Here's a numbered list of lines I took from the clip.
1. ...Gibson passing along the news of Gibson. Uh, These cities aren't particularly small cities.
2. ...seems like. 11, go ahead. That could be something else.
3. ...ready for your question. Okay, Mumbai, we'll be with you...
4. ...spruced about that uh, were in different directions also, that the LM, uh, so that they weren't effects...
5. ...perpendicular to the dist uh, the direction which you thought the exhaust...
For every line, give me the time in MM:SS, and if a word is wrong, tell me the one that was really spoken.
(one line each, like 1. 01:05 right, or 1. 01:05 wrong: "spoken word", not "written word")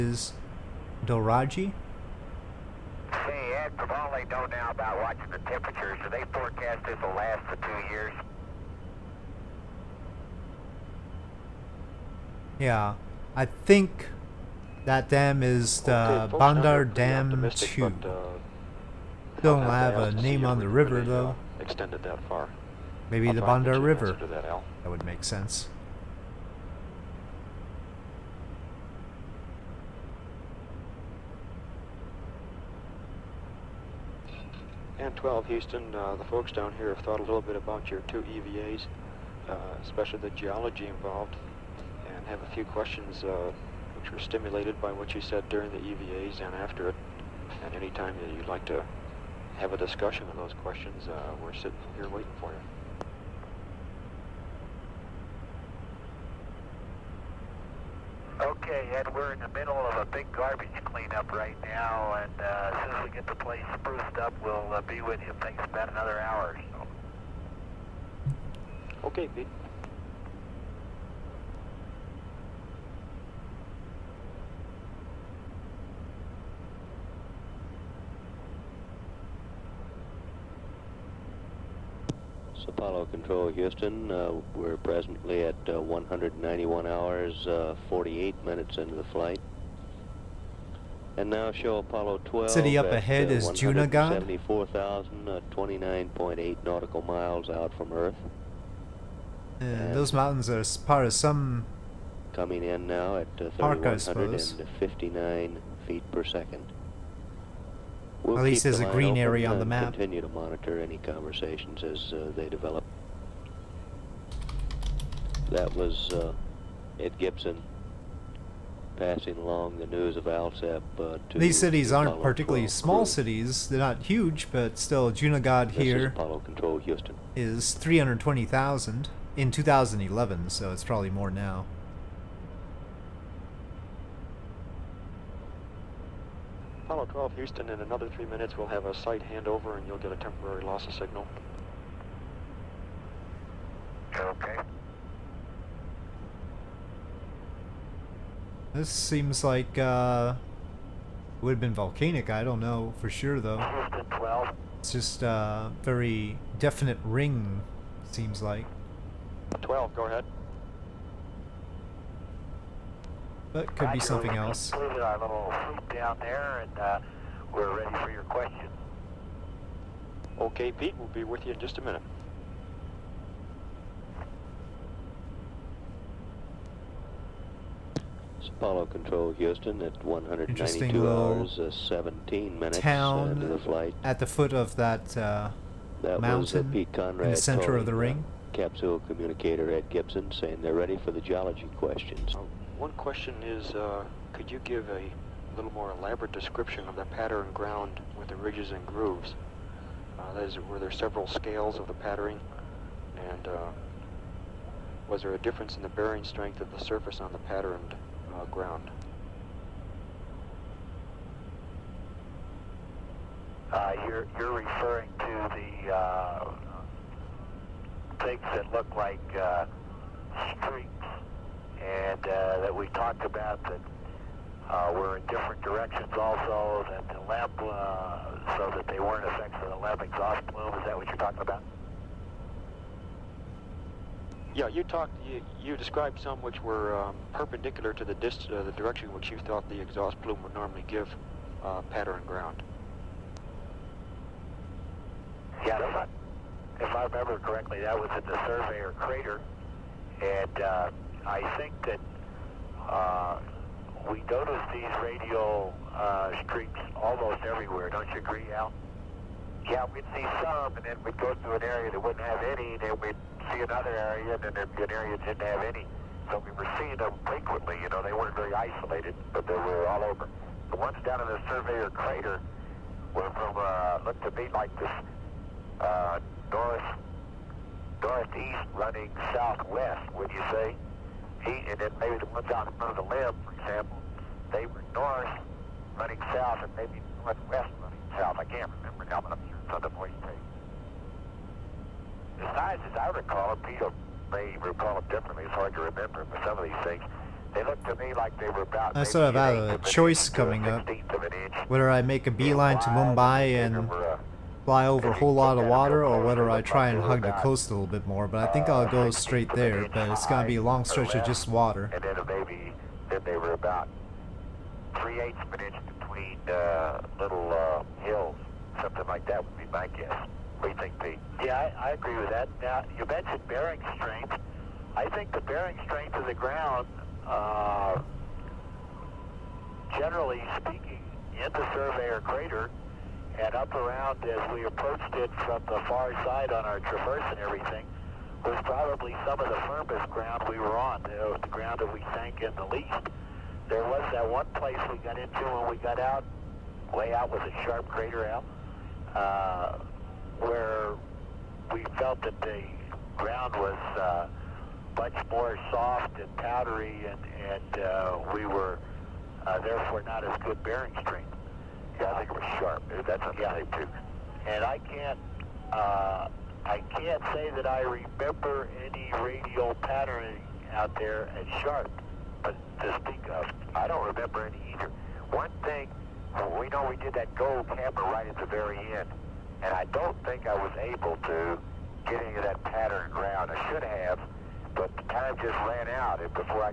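1. 01:57 wrong: "Alsep", not "Gibson"
2. 02:38 wrong: "12", not "11"
3. 02:47 wrong: "Pete", not "Mumbai"
4. 03:42 wrong: "talked", not "spruced"
5. 03:57 right.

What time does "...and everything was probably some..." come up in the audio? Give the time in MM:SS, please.
05:37.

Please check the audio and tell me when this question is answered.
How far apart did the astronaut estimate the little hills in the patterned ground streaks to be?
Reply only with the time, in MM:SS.
05:15.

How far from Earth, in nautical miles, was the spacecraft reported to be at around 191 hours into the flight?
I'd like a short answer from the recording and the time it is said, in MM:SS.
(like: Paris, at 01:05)
74,029.8, at 01:34.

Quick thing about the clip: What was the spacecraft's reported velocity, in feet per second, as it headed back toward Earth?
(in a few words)
3,159.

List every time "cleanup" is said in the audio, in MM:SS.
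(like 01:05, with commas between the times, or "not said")
01:00.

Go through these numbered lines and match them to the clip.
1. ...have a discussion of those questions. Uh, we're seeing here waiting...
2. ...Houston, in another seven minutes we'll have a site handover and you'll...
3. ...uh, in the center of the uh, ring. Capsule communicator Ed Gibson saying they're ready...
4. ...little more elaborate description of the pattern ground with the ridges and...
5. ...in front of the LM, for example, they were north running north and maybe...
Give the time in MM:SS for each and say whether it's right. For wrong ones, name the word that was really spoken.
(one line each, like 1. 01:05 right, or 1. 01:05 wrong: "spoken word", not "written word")
1. 00:49 wrong: "sitting", not "seeing"
2. 02:17 wrong: "three", not "seven"
3. 03:06 right
4. 03:15 right
5. 04:42 wrong: "south", not "north".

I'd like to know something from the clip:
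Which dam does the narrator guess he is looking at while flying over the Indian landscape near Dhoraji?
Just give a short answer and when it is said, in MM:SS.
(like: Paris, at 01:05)
Bandar Dam 2, at 00:16.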